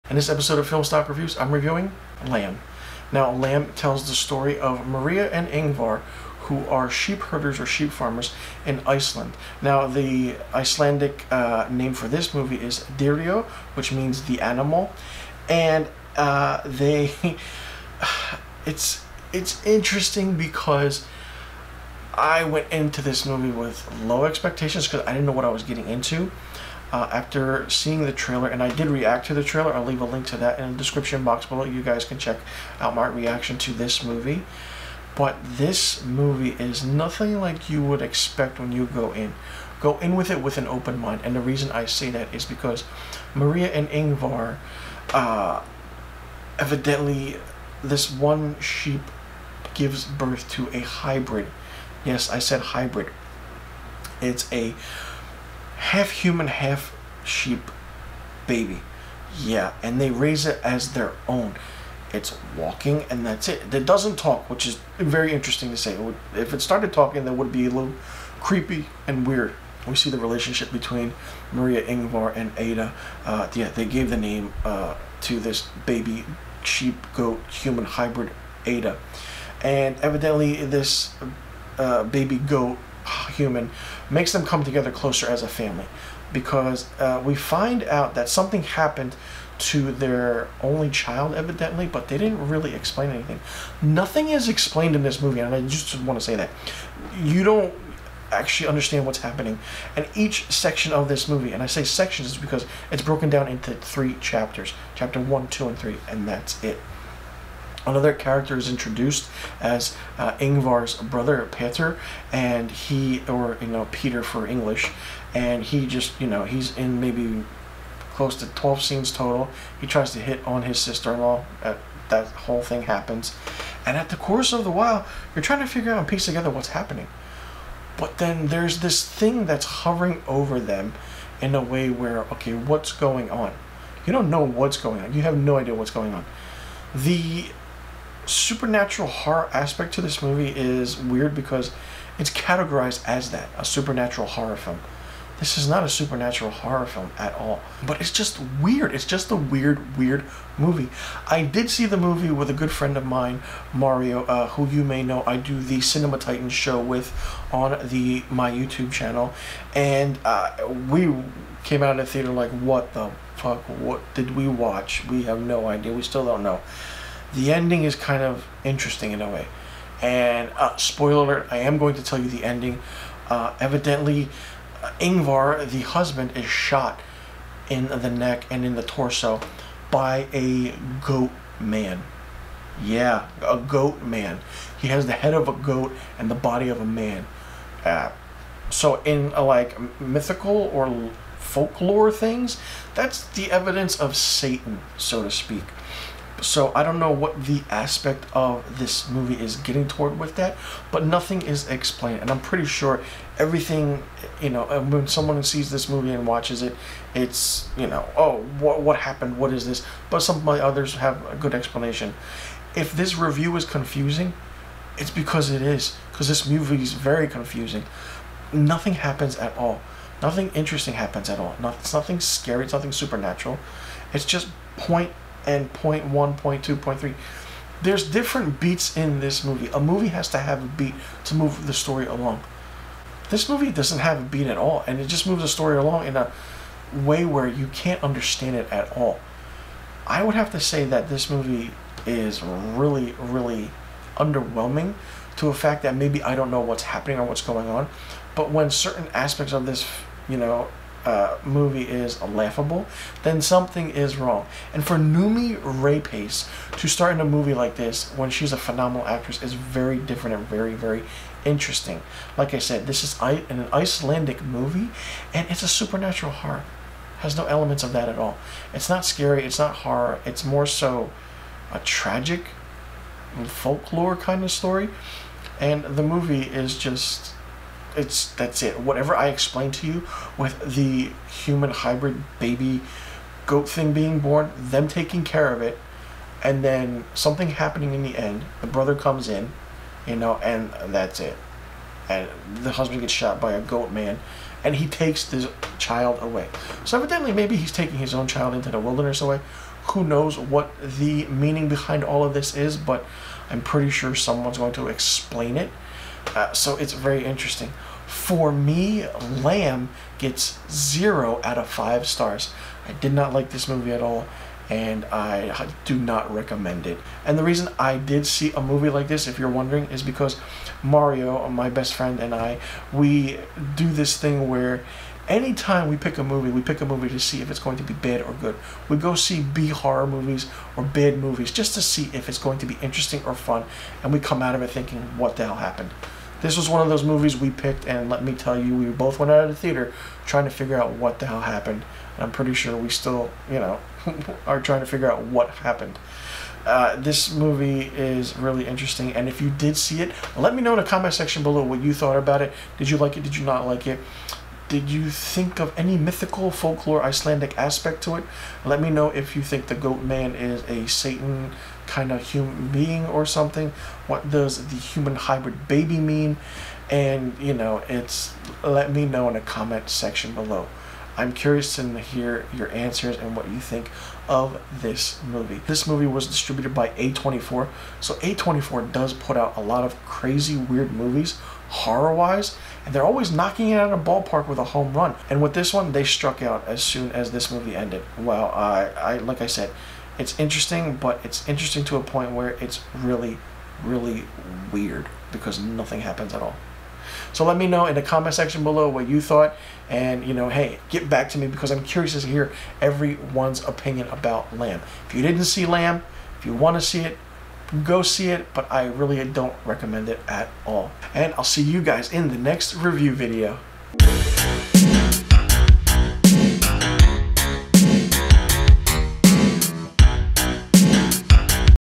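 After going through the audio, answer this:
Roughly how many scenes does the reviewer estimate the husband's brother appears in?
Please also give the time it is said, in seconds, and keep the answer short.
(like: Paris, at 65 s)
12, at 118 s.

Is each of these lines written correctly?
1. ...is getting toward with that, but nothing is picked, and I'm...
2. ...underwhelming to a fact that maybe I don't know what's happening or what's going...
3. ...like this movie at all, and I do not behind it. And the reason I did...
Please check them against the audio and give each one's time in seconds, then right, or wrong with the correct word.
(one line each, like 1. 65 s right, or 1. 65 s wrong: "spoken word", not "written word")
1. 199 s wrong: "explained", not "picked"
2. 244 s right
3. 313 s wrong: "recommend", not "behind".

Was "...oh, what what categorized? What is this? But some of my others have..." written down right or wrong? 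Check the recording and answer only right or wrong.
wrong.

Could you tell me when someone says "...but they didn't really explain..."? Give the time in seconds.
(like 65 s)
91 s.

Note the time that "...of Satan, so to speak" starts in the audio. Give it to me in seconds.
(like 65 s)
193 s.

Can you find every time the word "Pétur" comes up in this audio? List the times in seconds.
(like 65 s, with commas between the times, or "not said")
111 s.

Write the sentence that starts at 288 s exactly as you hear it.
The brother comes in, you know, and that's it.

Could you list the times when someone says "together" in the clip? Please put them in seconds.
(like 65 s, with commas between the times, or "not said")
84 s, 126 s.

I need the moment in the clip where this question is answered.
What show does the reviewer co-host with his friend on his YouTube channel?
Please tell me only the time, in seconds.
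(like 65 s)
155 s.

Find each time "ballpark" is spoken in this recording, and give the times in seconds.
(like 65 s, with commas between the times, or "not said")
384 s.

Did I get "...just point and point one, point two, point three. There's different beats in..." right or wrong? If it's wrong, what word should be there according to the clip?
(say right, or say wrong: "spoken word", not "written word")
right.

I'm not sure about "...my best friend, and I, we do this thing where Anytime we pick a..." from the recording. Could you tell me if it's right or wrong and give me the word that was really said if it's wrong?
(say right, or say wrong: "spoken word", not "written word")
right.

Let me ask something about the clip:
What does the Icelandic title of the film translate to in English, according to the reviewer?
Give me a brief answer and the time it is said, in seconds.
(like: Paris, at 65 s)
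The animal, at 14 s.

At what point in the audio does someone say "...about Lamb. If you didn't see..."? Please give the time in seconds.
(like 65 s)
404 s.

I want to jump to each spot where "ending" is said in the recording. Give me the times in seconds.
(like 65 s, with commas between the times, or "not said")
167 s, 172 s.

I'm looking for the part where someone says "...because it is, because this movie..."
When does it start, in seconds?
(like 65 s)
215 s.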